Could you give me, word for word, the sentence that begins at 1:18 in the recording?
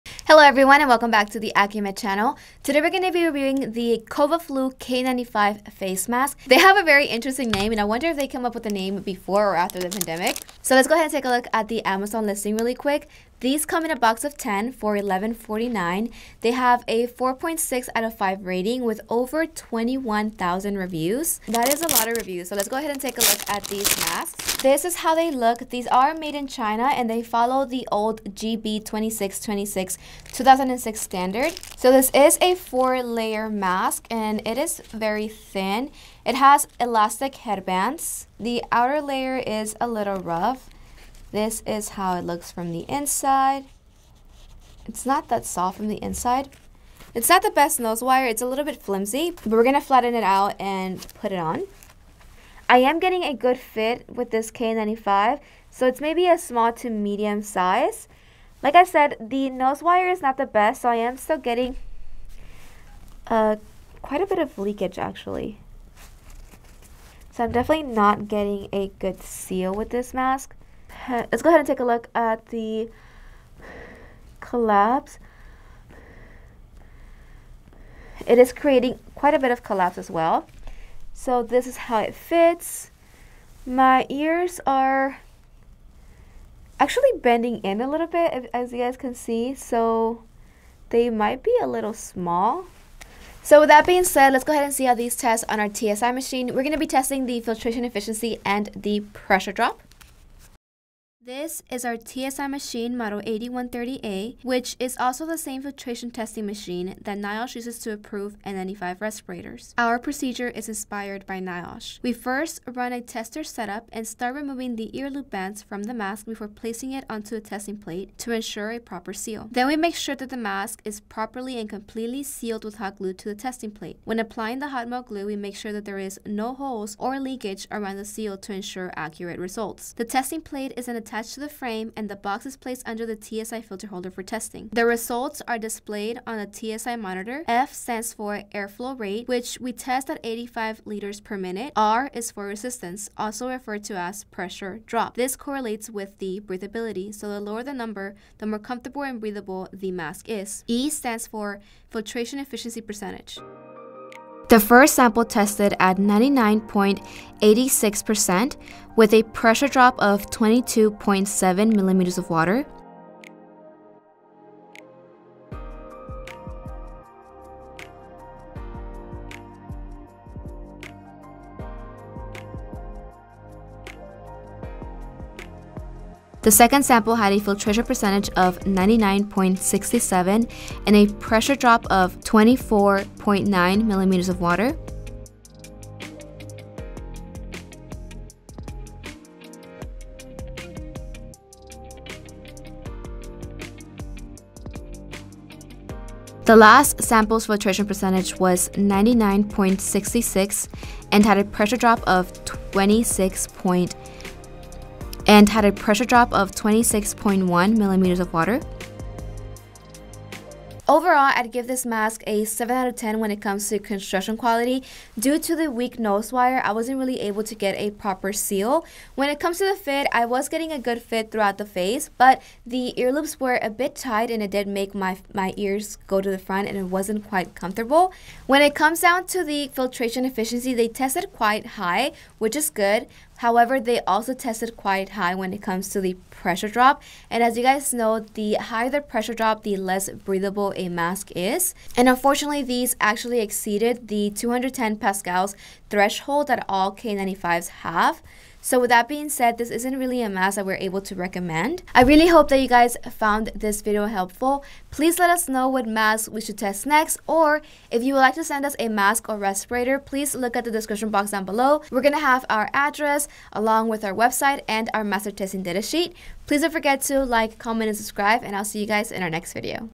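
It is creating quite a bit of collapse as well.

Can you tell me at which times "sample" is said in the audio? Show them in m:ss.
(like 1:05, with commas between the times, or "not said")
2:34, 2:56, 3:17.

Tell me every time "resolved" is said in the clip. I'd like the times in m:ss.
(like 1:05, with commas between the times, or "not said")
not said.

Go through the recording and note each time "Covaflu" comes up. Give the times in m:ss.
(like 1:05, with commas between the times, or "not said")
0:04.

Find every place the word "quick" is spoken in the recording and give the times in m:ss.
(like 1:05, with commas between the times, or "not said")
0:12.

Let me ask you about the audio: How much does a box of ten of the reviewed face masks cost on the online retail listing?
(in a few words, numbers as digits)
$11.49.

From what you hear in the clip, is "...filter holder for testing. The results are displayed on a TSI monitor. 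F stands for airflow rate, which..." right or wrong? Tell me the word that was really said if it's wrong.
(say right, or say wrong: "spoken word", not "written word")
right.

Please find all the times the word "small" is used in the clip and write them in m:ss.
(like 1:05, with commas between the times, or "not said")
0:56, 1:31.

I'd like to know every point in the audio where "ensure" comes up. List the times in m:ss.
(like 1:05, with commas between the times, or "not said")
1:58, 2:08.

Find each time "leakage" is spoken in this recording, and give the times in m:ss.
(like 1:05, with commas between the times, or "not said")
1:04, 2:07.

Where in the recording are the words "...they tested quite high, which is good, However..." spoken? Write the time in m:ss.
3:50.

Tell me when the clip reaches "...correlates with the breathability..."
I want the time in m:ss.
2:25.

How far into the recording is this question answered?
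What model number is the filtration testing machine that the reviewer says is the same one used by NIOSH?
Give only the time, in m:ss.
1:43.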